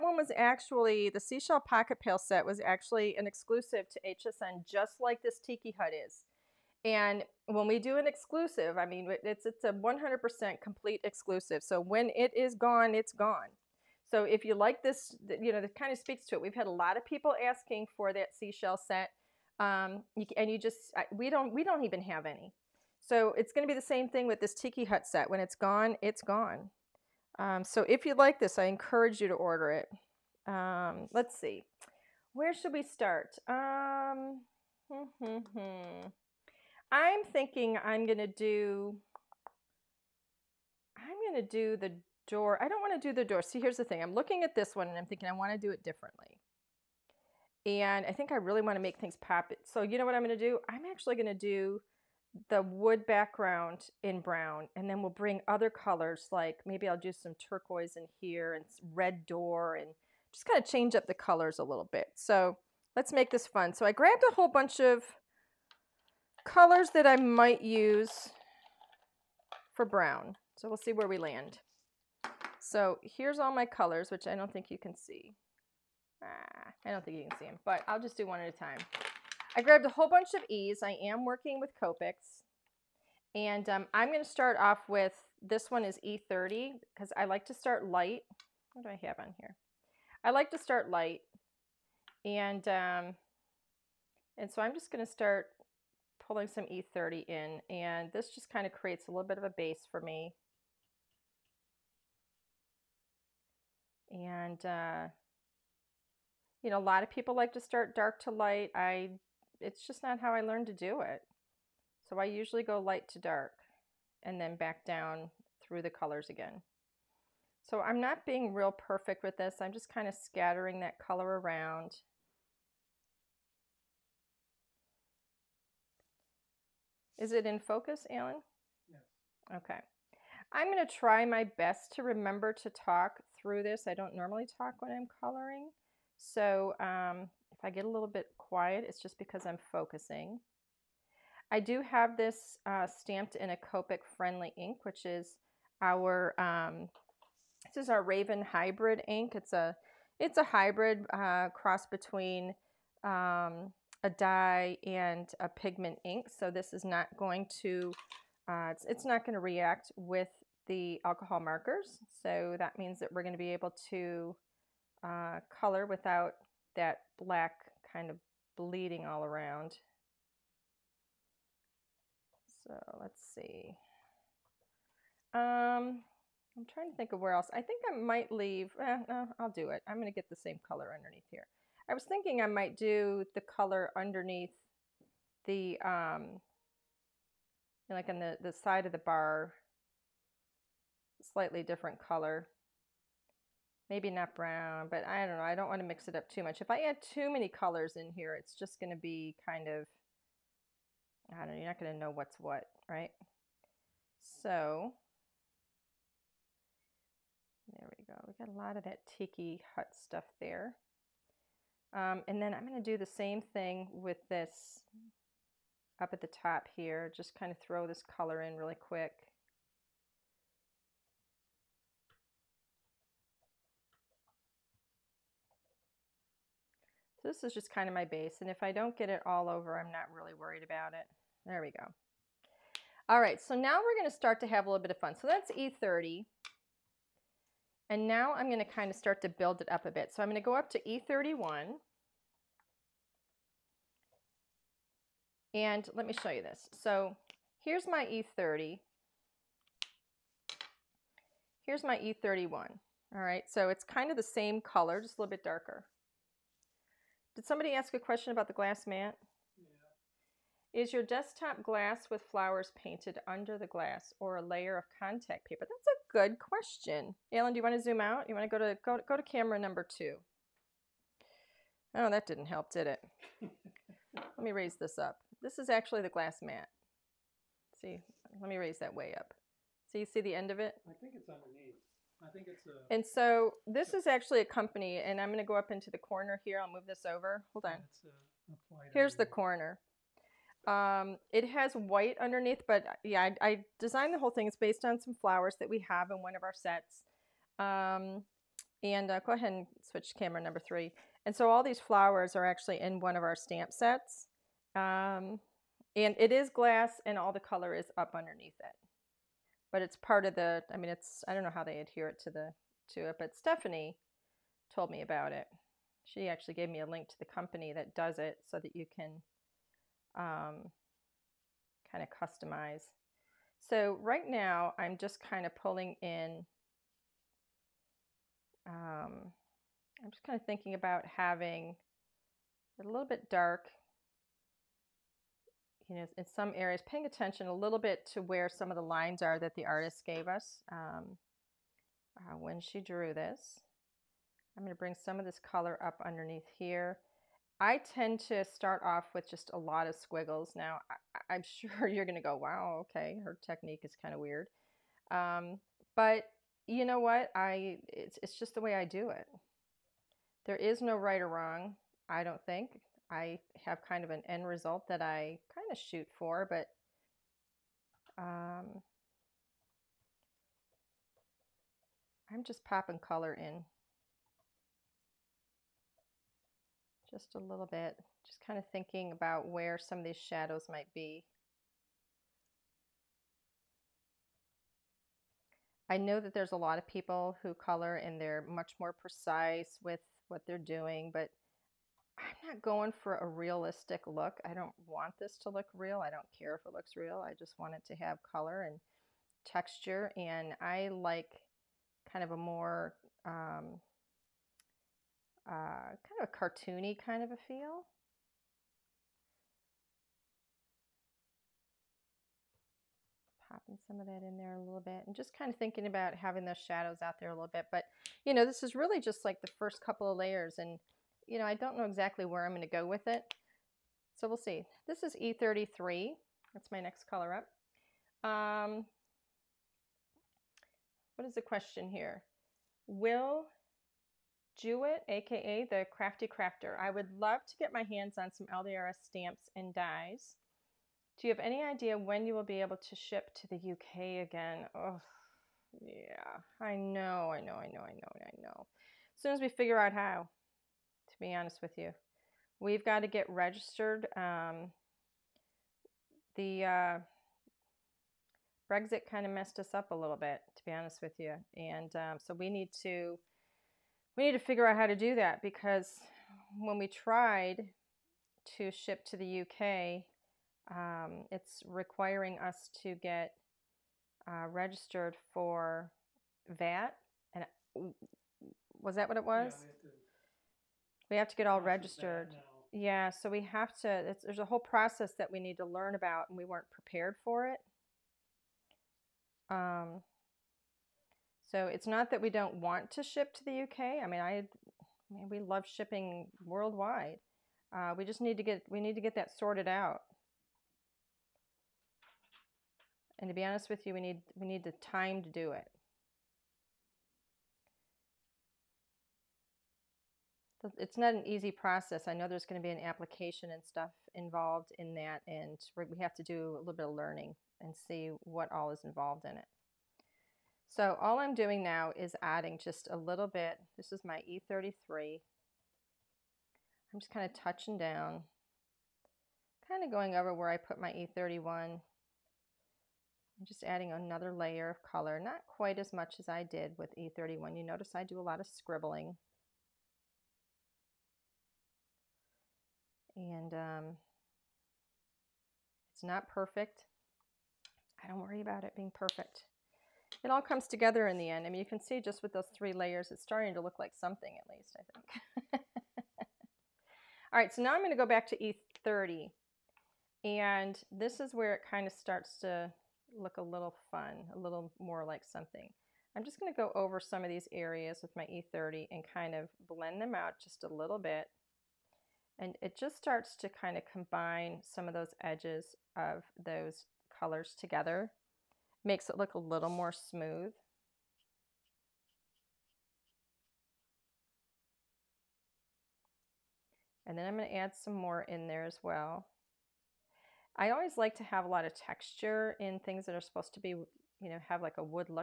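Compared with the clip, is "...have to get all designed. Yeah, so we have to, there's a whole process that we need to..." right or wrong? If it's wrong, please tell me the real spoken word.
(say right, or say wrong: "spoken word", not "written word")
wrong: "registered", not "designed".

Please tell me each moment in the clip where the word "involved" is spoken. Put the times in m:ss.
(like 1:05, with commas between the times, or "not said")
8:34, 8:38.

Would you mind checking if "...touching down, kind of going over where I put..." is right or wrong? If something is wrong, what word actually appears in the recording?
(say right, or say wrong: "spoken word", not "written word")
right.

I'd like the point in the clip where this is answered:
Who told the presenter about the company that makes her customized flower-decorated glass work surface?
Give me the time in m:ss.
5:13.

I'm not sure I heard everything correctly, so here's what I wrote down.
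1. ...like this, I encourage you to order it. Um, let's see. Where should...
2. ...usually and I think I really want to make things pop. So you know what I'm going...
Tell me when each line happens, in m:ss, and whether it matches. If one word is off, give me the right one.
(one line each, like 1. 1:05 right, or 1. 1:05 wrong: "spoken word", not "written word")
1. 0:28 right
2. 0:45 wrong: "differently", not "usually".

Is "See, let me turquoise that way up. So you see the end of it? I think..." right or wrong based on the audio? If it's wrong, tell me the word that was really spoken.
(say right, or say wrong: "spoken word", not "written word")
wrong: "raise", not "turquoise".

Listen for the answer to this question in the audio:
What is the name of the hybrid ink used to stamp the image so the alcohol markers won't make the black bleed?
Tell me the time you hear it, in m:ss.
2:28.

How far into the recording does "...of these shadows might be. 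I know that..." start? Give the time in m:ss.
6:19.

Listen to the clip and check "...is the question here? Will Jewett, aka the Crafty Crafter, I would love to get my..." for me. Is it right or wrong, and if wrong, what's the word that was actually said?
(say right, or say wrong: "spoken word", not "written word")
right.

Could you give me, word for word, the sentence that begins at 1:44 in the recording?
And uh, you know, a lot of people like to start dark to light.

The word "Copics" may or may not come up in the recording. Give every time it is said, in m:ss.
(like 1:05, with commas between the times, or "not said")
1:21, 2:23.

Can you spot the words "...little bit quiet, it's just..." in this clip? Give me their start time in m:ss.
2:17.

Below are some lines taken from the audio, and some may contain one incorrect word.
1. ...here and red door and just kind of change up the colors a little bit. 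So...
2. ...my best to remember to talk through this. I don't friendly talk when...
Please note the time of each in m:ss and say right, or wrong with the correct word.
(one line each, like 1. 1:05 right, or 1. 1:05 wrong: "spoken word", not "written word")
1. 0:58 right
2. 2:11 wrong: "normally", not "friendly".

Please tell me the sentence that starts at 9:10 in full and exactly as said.
It all comes together in the end.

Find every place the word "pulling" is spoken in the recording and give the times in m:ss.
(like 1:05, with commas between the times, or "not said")
1:36, 5:25.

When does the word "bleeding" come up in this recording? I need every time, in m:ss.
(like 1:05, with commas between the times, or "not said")
2:48.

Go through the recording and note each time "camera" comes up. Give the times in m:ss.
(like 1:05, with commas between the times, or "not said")
4:29, 5:00.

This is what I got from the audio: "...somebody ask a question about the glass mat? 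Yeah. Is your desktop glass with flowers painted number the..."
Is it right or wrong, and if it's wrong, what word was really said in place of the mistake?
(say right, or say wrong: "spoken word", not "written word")
wrong: "under", not "number".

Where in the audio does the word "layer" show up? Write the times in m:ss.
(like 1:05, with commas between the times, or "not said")
4:24, 7:00, 8:54, 9:12.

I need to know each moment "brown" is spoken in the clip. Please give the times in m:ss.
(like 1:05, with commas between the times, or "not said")
0:54, 1:09, 3:14.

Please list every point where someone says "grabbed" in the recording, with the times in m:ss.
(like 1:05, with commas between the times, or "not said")
1:03, 1:19.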